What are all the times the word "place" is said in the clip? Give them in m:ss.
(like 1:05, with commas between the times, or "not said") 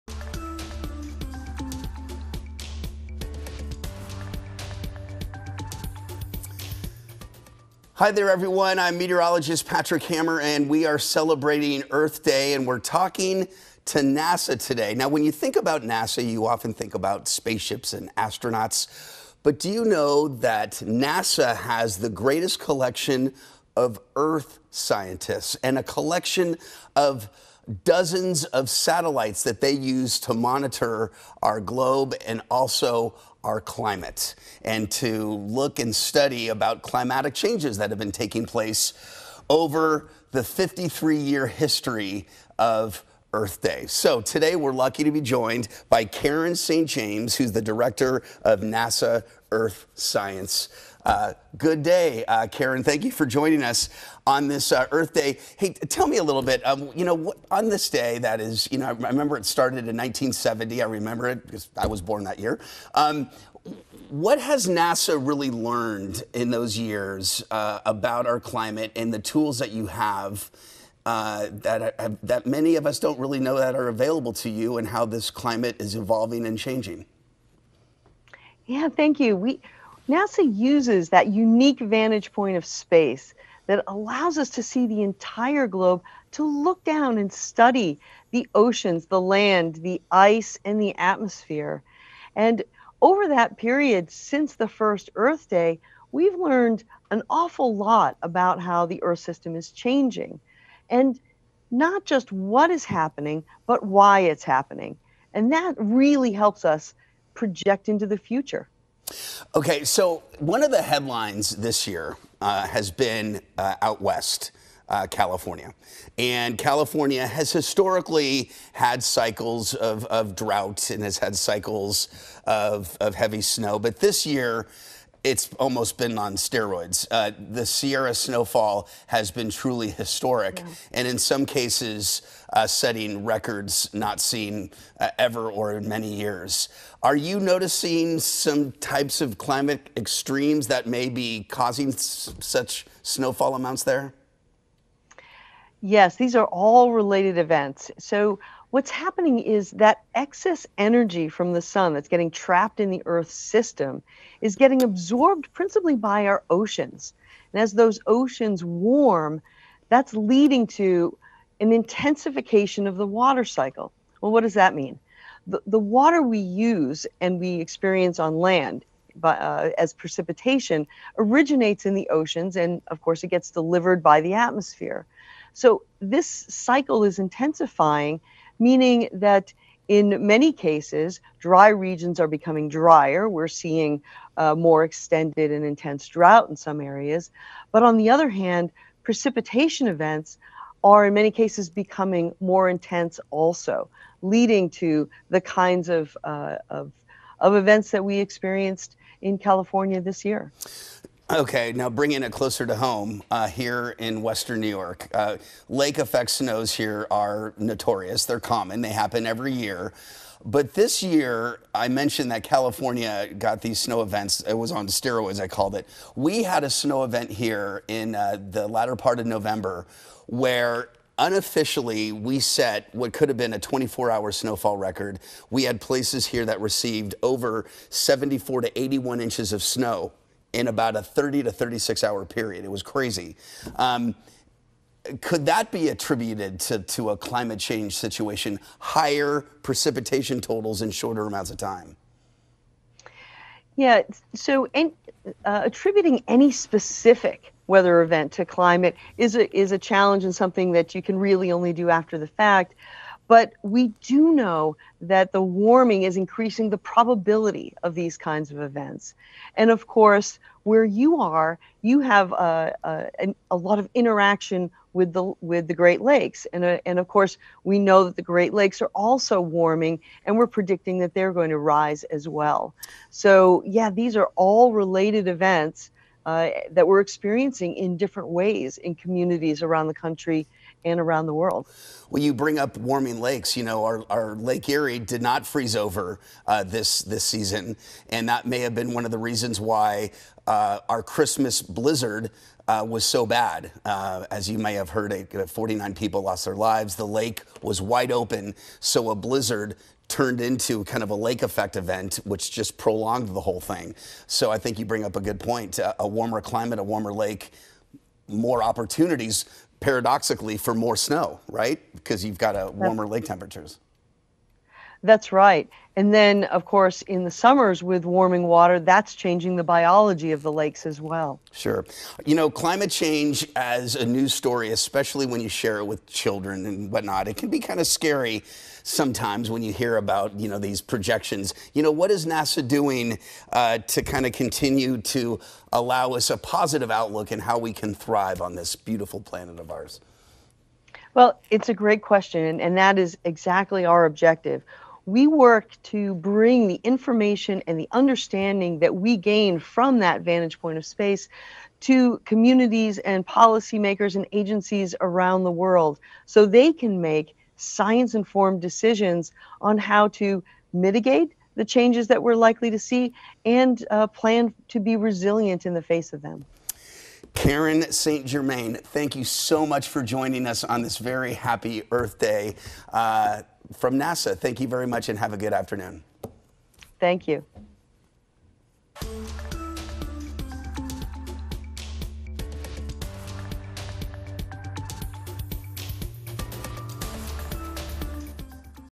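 0:38, 3:45.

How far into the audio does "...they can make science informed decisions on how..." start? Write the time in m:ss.
5:56.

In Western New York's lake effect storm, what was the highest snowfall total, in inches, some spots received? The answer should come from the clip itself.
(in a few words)
81.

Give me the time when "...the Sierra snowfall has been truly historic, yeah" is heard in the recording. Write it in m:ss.
2:07.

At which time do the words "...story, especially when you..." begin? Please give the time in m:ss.
5:24.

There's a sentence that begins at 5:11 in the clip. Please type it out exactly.
Because you've got a warmer lake temperatures.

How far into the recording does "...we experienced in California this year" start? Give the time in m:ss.
3:18.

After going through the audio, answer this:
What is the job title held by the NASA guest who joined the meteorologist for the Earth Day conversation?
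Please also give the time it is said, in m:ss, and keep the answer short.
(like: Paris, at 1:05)
Director of NASA Earth Science, at 0:47.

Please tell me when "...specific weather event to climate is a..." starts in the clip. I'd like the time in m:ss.
4:06.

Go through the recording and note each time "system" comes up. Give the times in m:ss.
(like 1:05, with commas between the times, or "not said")
1:39, 2:33.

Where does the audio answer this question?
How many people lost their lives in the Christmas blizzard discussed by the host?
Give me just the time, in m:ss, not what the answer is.
4:55.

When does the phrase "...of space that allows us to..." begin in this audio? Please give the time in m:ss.
1:22.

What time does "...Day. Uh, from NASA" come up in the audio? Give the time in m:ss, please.
6:12.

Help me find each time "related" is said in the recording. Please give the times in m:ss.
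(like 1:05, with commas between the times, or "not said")
2:26, 4:34.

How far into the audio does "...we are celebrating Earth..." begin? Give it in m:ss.
0:10.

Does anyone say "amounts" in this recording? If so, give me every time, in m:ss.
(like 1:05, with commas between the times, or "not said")
2:23, 4:01.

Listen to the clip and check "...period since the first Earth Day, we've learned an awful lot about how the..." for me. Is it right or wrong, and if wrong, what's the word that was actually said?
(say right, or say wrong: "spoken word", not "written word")
right.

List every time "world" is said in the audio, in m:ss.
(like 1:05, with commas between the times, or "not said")
4:41, 5:55.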